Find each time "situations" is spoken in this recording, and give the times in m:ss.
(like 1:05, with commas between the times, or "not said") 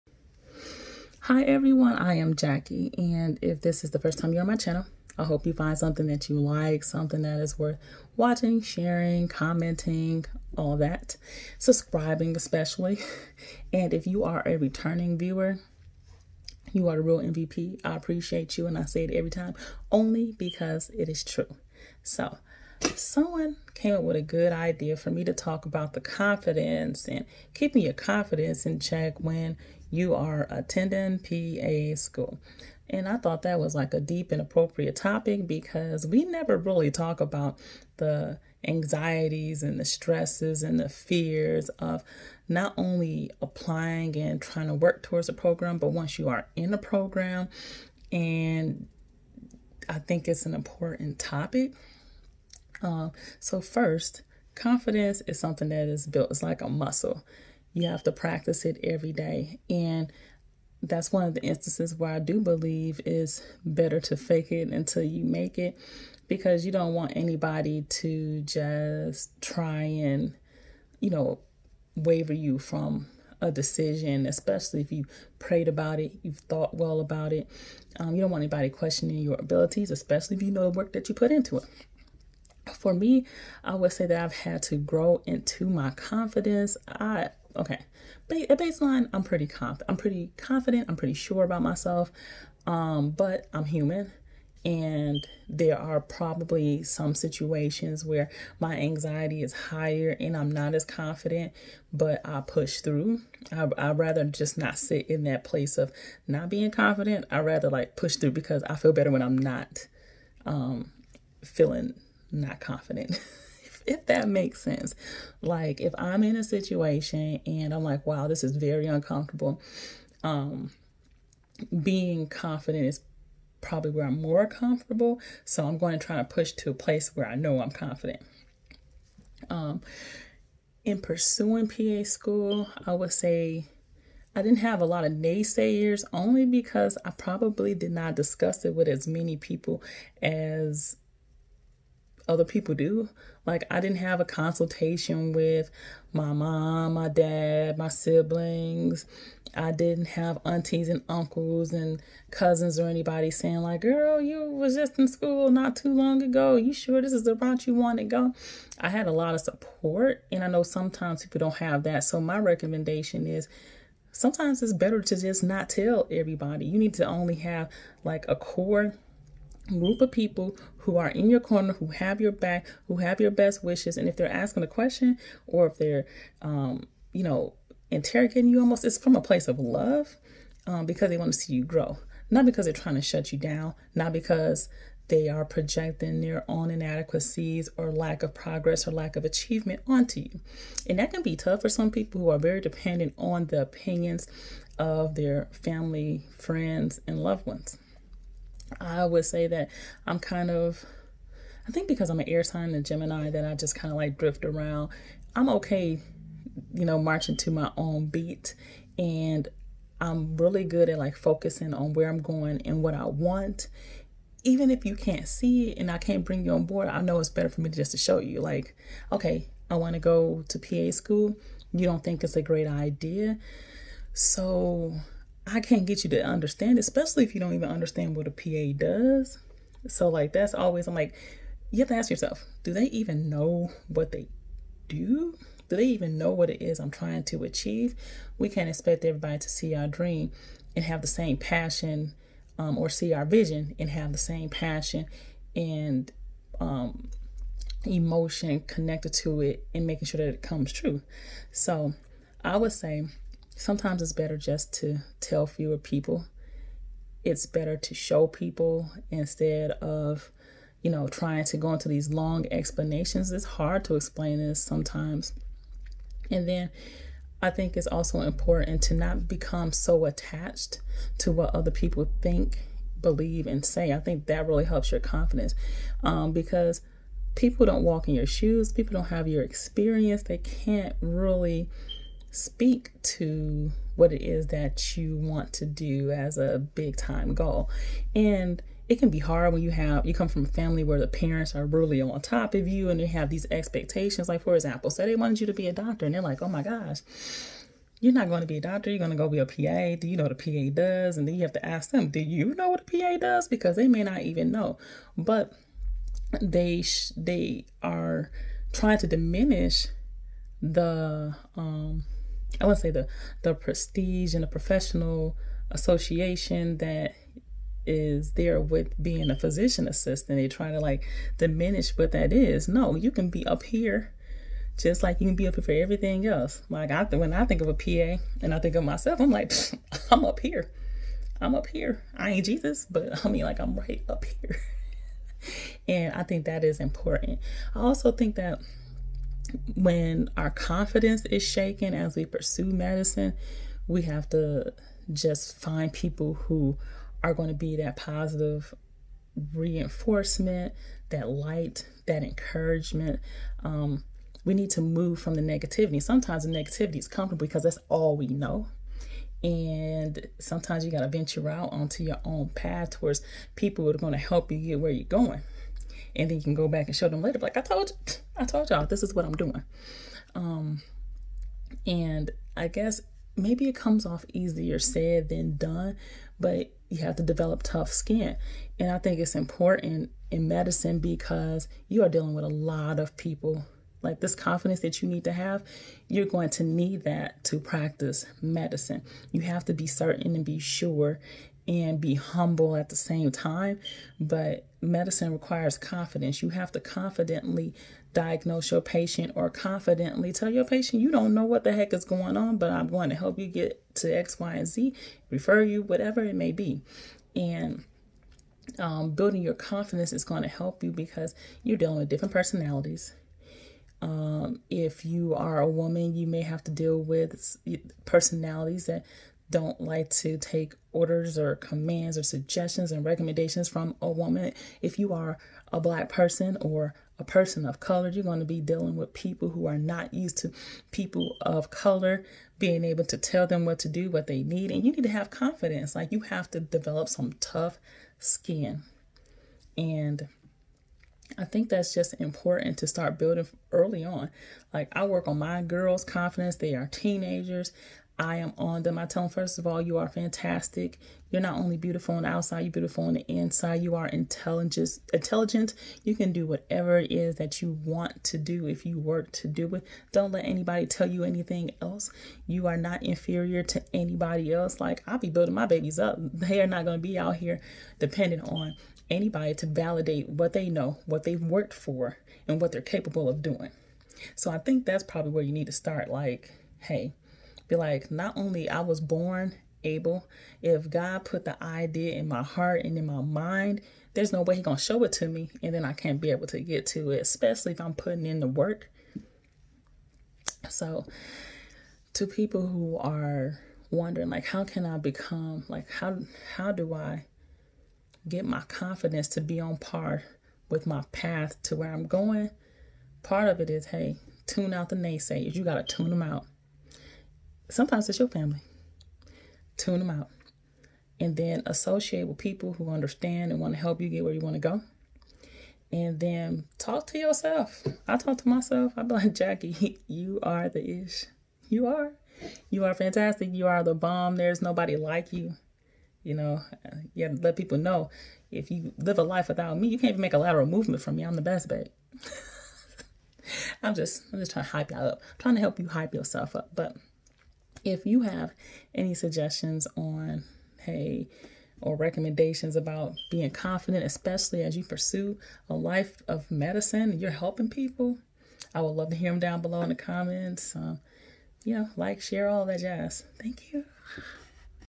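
1:37, 1:56.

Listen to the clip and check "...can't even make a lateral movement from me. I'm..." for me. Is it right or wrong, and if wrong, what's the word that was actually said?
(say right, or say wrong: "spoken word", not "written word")
right.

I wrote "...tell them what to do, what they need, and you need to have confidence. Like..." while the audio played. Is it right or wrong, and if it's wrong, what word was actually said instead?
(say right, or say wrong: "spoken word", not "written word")
right.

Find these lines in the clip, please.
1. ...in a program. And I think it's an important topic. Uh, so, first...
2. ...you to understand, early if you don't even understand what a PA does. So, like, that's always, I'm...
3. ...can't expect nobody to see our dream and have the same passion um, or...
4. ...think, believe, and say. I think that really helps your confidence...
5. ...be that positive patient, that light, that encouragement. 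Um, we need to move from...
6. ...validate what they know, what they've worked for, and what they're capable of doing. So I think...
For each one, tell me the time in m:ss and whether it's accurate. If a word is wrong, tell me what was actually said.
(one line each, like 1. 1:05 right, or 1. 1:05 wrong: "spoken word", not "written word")
1. 0:46 right
2. 3:46 wrong: "especially", not "early"
3. 3:58 wrong: "everybody", not "nobody"
4. 4:32 right
5. 5:47 wrong: "reinforcement", not "patient"
6. 7:49 right.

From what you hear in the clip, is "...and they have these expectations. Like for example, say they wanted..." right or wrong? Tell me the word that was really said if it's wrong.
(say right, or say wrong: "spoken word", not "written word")
right.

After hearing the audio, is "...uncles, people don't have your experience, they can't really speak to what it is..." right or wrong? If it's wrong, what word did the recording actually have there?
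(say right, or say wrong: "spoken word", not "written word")
wrong: "shoes", not "uncles".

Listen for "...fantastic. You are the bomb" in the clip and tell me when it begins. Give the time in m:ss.
8:42.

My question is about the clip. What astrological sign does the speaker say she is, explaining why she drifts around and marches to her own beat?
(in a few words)
Gemini.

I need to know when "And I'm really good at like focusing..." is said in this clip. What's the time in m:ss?
3:28.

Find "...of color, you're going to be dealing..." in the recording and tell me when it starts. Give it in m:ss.
7:07.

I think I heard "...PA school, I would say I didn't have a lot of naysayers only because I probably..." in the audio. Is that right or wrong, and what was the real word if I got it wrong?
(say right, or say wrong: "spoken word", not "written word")
right.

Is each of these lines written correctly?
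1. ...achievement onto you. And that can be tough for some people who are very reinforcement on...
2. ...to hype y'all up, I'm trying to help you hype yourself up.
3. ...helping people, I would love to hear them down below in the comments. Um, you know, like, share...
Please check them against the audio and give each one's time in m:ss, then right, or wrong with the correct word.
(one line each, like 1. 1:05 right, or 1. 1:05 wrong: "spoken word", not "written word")
1. 3:09 wrong: "dependent", not "reinforcement"
2. 8:54 right
3. 9:07 right.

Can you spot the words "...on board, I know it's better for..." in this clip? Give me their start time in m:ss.
3:36.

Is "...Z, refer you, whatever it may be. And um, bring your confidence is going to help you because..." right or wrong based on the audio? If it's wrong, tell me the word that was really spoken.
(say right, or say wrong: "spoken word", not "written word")
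wrong: "building", not "bring".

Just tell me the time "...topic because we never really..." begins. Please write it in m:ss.
0:34.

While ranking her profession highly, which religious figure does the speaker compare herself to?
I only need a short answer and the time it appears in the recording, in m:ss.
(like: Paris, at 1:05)
Jesus, at 5:32.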